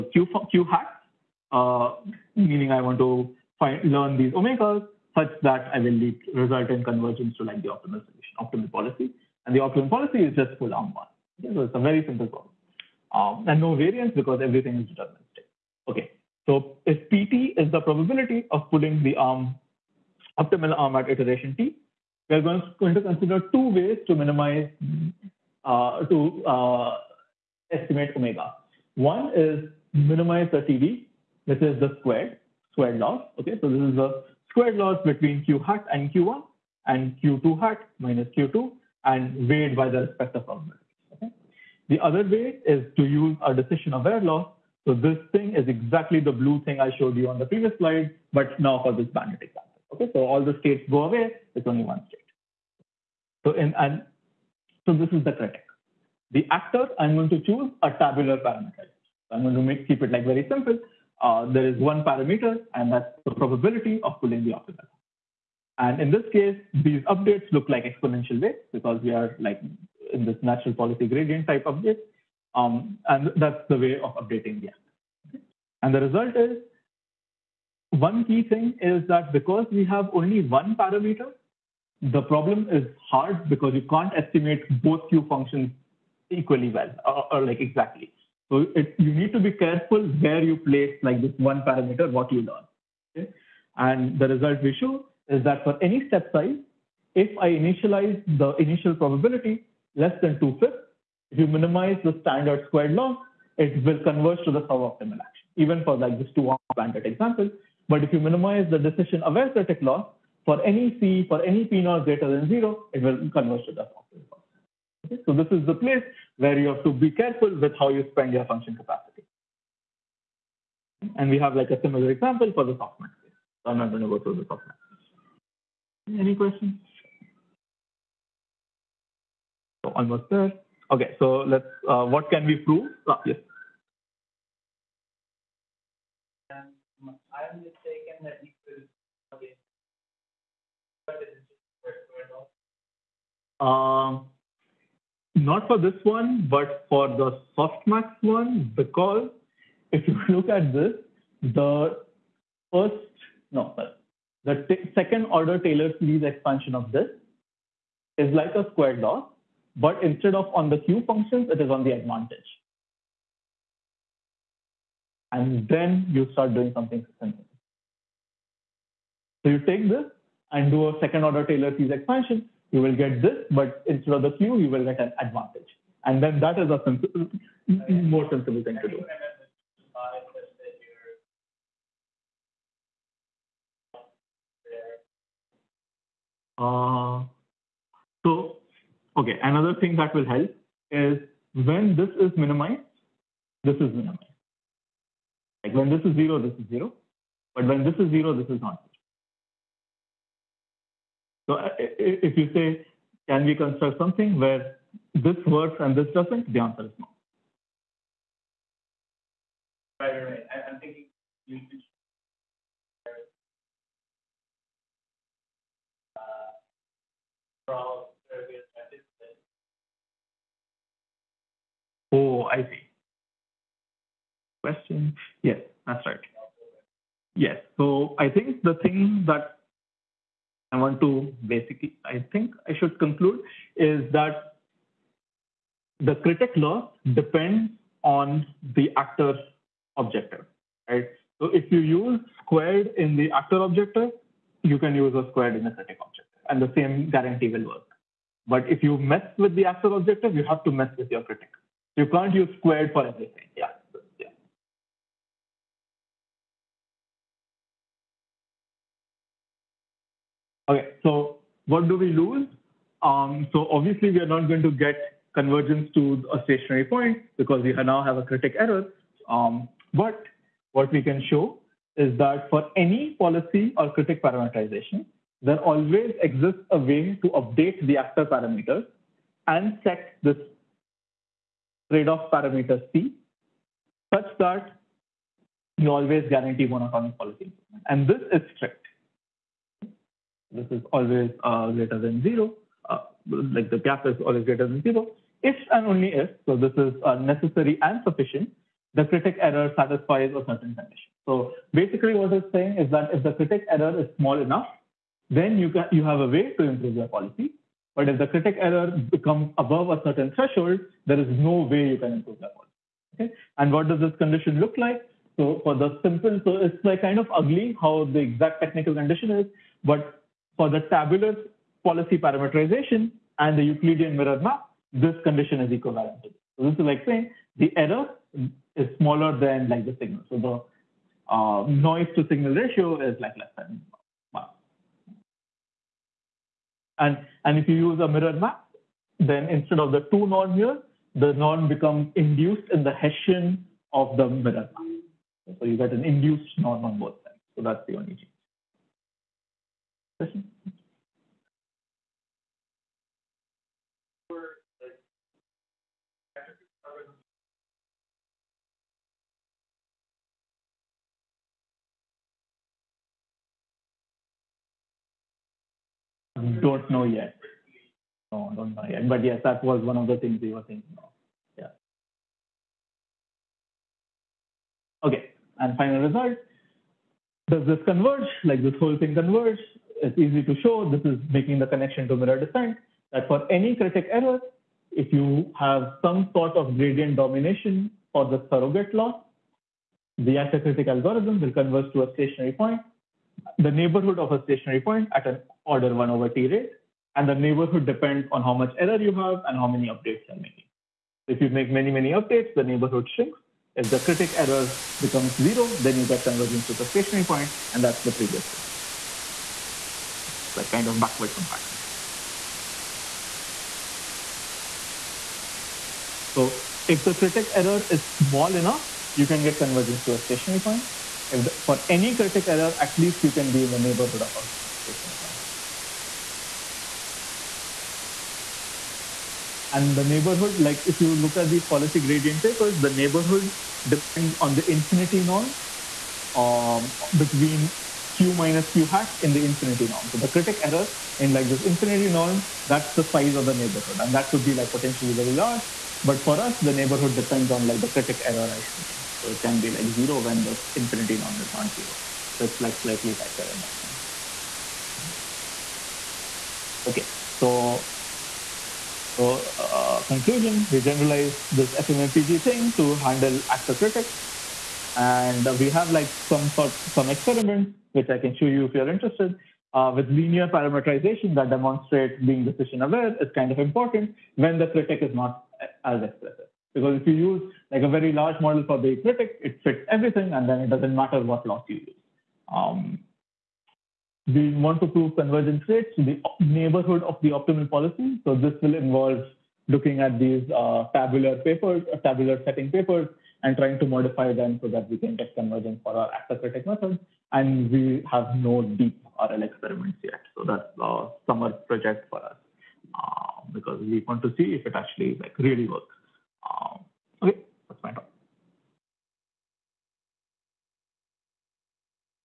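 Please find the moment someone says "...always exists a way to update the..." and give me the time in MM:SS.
04:35.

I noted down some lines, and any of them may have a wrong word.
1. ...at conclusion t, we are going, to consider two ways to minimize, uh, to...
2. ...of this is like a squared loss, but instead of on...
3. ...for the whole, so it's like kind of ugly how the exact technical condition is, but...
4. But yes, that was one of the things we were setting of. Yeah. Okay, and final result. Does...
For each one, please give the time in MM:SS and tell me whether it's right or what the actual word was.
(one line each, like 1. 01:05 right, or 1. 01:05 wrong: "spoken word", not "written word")
1. 00:20 wrong: "iteration", not "conclusion"
2. 02:36 right
3. 05:15 wrong: "simple", not "whole"
4. 06:09 wrong: "thinking", not "setting".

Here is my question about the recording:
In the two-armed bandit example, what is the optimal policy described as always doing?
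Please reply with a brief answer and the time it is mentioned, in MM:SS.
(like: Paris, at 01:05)
Pull arm 1, at 00:10.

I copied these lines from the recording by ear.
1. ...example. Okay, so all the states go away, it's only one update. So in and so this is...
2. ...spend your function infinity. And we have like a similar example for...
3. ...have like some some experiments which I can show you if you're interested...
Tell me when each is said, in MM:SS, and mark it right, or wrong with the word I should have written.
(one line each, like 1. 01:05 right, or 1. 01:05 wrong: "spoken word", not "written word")
1. 00:49 wrong: "state", not "update"
2. 01:58 wrong: "capacity", not "infinity"
3. 07:45 right.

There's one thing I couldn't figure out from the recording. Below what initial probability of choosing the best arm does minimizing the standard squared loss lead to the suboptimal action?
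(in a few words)
2/5.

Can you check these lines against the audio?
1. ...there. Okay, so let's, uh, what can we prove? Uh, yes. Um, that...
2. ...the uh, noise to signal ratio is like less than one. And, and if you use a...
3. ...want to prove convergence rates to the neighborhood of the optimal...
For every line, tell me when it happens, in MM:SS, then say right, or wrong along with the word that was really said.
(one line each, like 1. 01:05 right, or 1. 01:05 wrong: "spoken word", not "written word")
1. 02:10 right
2. 05:30 right
3. 08:04 right.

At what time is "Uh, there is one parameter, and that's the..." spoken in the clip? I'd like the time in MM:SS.
01:01.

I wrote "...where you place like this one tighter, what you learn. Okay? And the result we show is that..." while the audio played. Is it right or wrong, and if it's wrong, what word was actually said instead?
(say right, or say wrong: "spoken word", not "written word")
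wrong: "parameter", not "tighter".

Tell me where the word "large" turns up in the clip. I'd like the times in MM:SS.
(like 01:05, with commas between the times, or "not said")
07:25, 07:58.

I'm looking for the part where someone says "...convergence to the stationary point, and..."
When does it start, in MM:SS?
06:46.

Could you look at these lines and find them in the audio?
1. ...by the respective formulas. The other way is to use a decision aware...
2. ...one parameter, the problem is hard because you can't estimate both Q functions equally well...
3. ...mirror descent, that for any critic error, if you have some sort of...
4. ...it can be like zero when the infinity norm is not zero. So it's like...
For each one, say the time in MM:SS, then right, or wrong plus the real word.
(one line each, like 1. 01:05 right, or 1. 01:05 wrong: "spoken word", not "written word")
1. 00:39 right
2. 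01:20 right
3. 06:22 right
4. 07:29 right.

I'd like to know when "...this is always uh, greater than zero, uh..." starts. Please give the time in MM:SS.
04:50.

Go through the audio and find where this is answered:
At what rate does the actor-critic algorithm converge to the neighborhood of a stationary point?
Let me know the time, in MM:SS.
06:35.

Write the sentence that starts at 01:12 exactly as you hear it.
Um, and that's the way of updating the actor.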